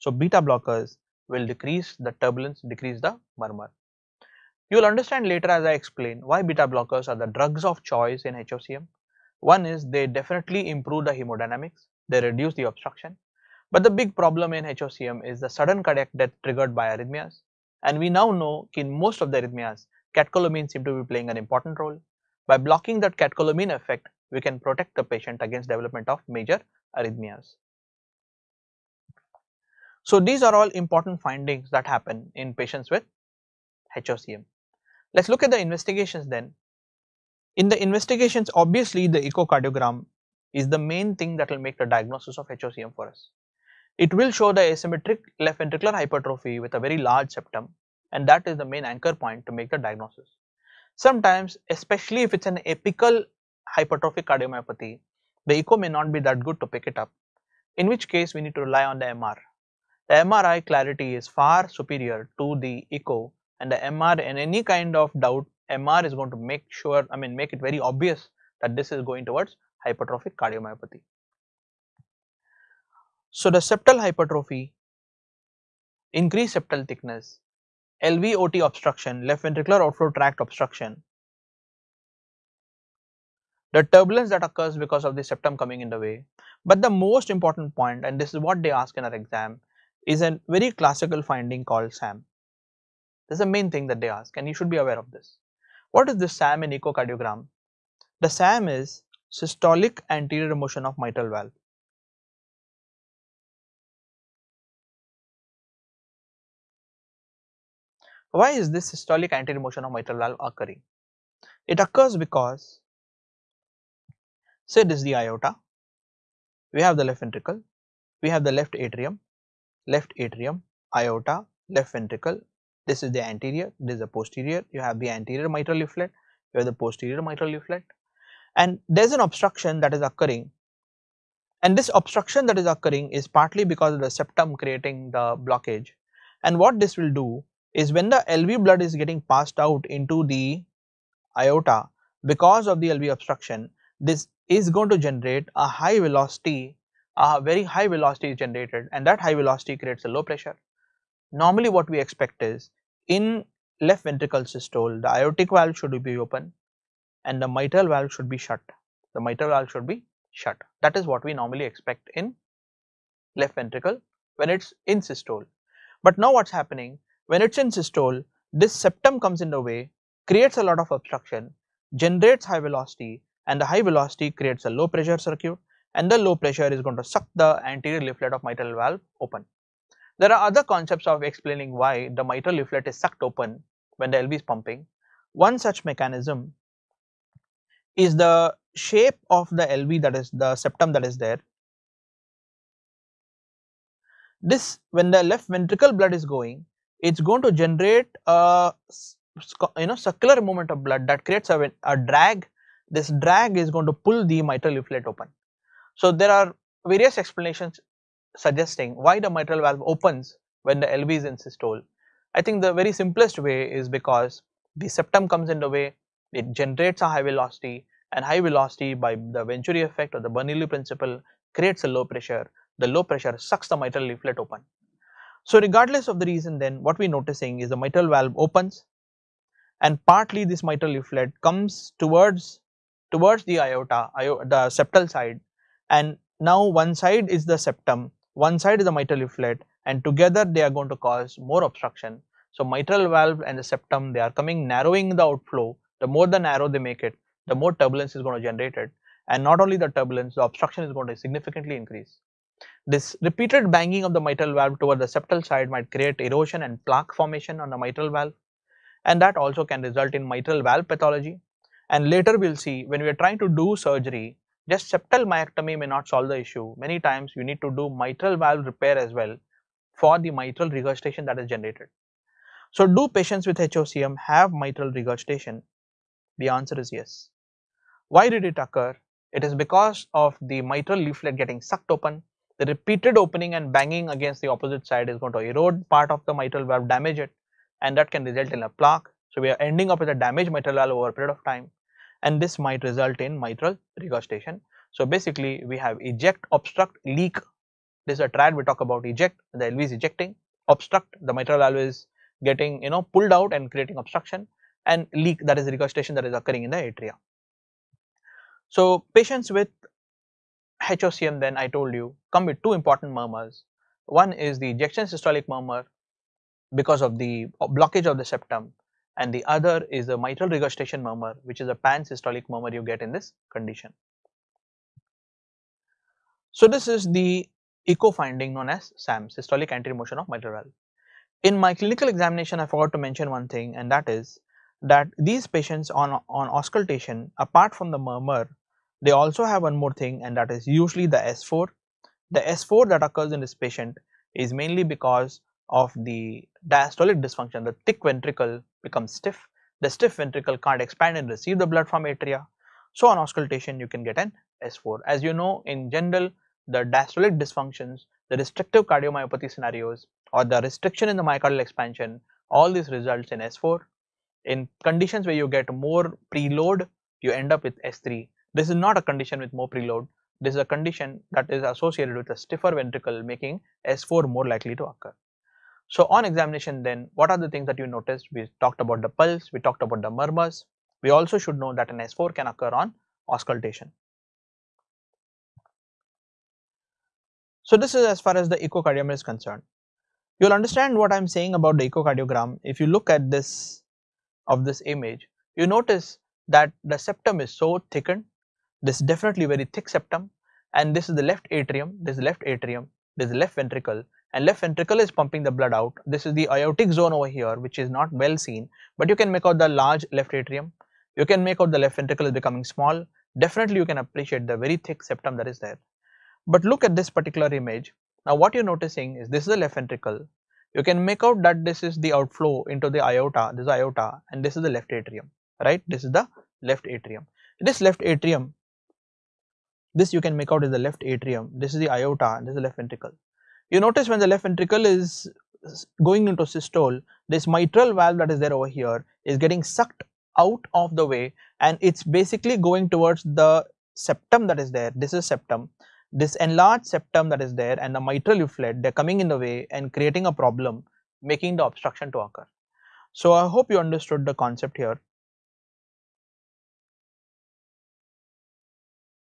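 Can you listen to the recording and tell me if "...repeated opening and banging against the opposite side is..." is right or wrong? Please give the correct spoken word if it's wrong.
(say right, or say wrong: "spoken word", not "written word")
right.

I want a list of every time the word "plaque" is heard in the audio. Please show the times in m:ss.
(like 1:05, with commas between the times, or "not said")
4:16, 4:48.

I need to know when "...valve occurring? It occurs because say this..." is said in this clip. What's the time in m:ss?
1:50.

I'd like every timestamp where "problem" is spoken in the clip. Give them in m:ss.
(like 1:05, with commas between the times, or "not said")
0:14, 7:30.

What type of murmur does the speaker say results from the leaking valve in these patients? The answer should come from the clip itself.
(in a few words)
Pan-systolic murmur.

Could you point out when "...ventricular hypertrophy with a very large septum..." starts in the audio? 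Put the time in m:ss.
0:45.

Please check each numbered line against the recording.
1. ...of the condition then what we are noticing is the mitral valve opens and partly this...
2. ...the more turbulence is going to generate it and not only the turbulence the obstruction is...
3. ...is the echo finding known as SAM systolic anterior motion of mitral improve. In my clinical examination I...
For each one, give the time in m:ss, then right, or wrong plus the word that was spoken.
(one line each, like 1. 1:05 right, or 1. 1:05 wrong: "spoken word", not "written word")
1. 3:46 wrong: "reason", not "condition"
2. 4:07 right
3. 5:26 wrong: "valve", not "improve".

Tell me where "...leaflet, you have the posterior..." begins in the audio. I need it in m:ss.
2:05.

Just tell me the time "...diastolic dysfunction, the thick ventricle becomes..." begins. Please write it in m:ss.
5:46.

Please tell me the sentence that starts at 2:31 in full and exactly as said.
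Normally what we expect is in left ventricle systole the aortic valve should be open and the mitral valve should be shut.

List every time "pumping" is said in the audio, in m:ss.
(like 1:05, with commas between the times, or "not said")
3:04, 6:45.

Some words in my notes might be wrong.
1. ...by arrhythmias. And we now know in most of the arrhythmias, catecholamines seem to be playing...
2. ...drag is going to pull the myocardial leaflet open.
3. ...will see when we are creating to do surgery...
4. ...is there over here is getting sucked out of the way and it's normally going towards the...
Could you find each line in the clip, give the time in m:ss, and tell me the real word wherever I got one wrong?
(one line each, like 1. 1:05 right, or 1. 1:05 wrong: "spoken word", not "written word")
1. 0:16 right
2. 3:23 wrong: "mitral", not "myocardial"
3. 4:22 wrong: "trying", not "creating"
4. 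7:18 wrong: "basically", not "normally".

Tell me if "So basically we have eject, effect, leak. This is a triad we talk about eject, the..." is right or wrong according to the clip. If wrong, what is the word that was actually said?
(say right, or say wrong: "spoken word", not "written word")
wrong: "obstruct", not "effect".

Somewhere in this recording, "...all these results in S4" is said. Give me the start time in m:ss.
6:02.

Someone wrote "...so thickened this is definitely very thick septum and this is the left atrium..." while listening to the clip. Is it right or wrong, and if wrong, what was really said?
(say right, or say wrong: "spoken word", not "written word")
right.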